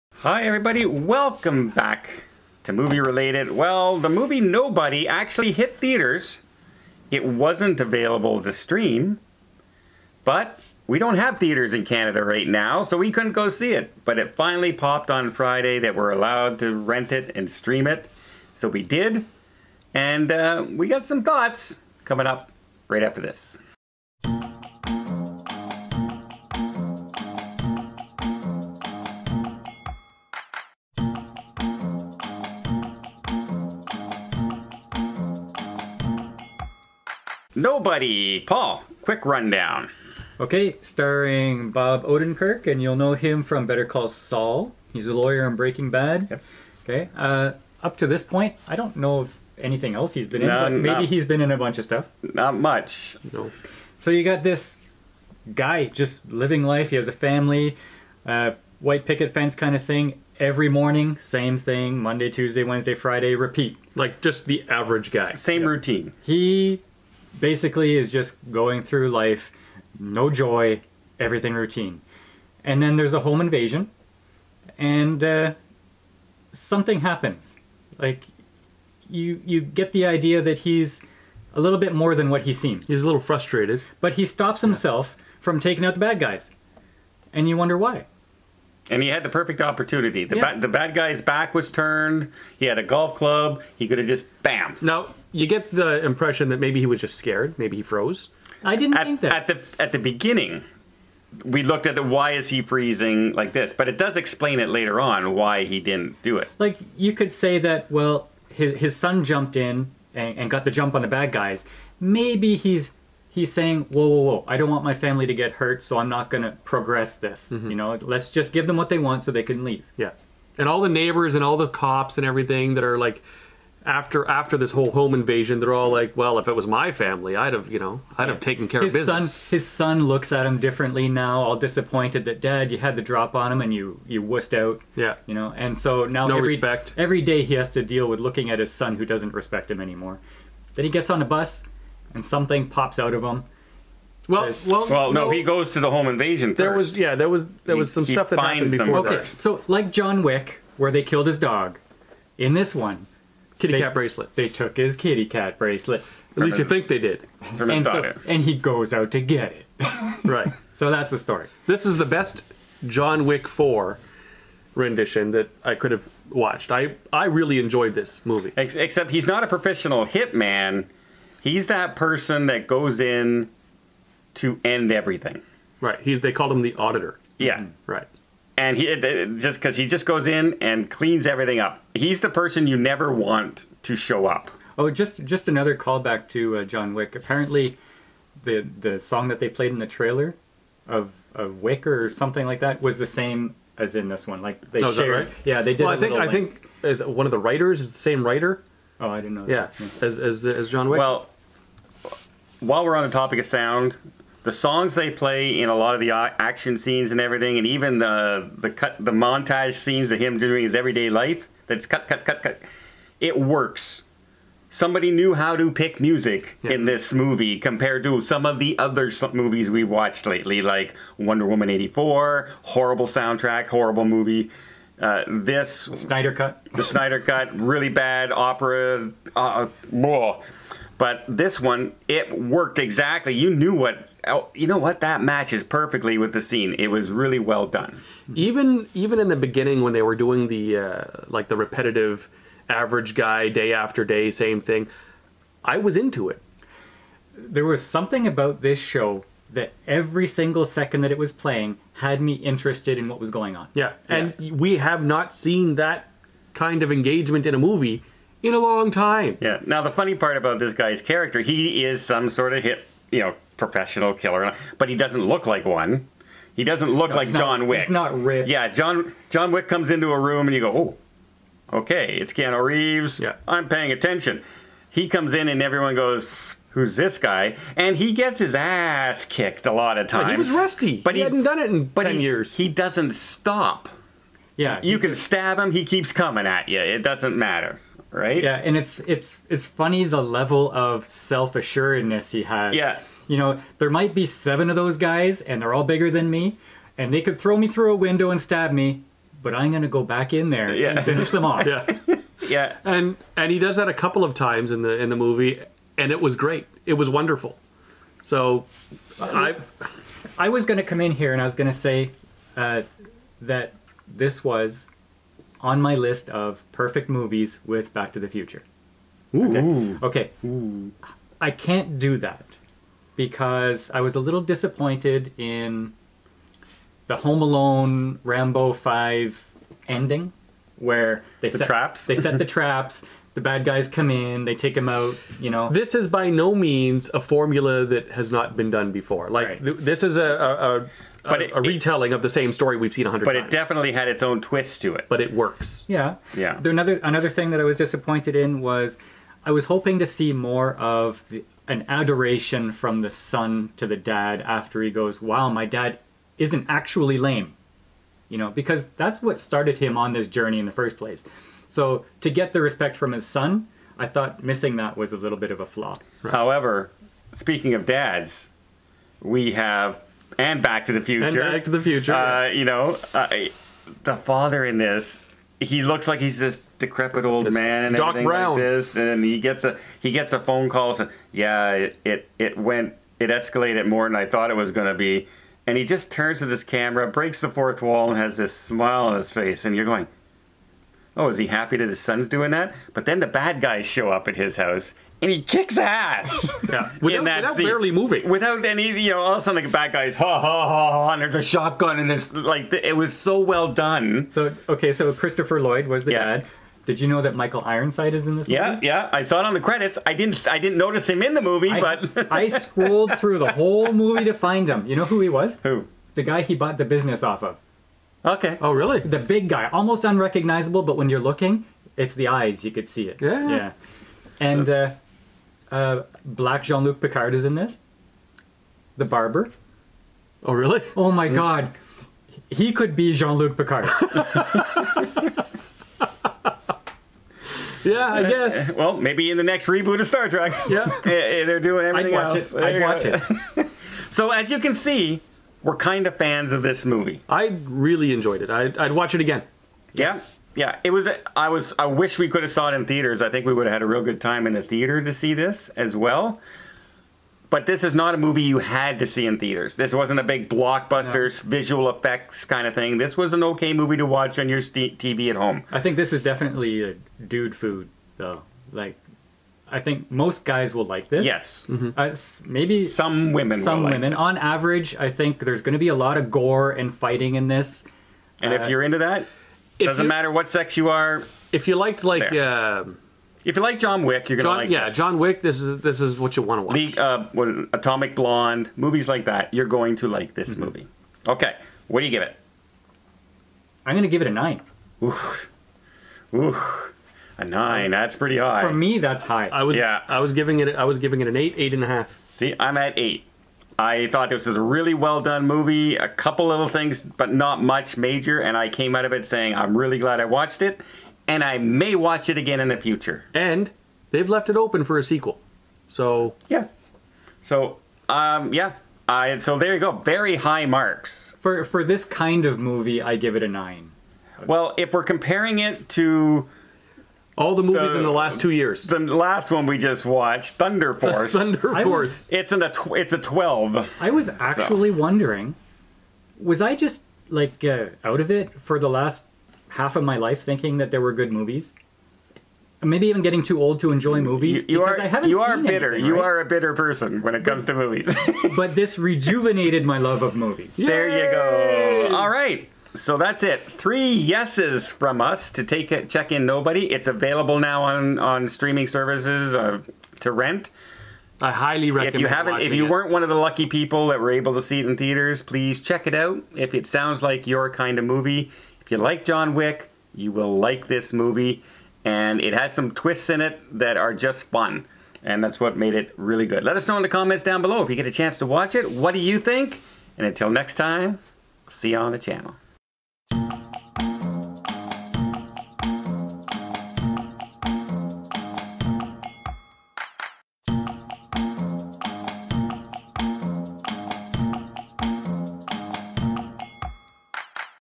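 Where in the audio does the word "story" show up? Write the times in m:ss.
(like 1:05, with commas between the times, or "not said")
2:41, 5:42.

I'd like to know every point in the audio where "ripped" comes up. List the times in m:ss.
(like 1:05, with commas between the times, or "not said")
4:28.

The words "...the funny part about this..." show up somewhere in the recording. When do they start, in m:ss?
4:19.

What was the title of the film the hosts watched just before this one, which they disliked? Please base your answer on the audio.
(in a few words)
Thunder Force.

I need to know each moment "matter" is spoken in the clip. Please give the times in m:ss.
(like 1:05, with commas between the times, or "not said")
4:47, 8:00.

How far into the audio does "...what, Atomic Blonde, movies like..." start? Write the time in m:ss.
8:07.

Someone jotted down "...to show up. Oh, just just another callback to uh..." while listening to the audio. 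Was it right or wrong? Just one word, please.
right.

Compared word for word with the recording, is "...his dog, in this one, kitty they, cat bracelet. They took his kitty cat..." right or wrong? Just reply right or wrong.
right.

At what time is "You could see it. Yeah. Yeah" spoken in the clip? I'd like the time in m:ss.
7:02.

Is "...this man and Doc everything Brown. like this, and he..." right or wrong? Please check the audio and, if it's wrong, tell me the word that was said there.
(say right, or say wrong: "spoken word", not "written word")
right.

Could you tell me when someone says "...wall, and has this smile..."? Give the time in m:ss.
6:27.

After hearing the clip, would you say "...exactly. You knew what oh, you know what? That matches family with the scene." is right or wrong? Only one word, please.
wrong.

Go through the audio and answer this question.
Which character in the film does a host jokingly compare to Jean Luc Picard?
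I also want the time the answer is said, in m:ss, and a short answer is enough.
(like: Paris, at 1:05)
The barber, at 7:08.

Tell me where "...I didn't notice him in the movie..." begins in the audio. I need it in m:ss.
6:50.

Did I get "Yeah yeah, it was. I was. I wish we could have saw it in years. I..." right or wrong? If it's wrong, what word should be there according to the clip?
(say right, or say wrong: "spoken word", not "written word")
wrong: "theaters", not "years".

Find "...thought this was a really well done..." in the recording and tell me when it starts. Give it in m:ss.
8:24.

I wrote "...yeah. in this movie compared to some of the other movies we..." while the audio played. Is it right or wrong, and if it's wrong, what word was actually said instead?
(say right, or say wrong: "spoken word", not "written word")
right.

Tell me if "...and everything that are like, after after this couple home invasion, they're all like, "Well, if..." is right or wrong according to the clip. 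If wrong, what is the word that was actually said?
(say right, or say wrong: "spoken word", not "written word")
wrong: "whole", not "couple".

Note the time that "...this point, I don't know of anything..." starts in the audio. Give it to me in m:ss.
0:48.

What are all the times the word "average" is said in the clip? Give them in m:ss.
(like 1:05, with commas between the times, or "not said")
1:04, 4:02, 7:54.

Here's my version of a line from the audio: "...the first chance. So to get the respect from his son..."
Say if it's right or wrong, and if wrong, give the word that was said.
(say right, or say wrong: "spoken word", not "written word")
wrong: "place", not "chance".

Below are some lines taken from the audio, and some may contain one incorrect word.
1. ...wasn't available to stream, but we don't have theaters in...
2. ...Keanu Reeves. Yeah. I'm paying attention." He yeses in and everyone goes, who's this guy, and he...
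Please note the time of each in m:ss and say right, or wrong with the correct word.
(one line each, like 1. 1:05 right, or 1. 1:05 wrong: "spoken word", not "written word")
1. 0:07 right
2. 4:32 wrong: "comes", not "yeses".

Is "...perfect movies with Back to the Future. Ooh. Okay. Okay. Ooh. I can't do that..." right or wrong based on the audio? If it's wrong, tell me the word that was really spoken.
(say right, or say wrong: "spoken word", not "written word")
right.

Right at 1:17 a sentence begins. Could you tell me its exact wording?
Like you, you get the idea that he's a little bit more than what he seems.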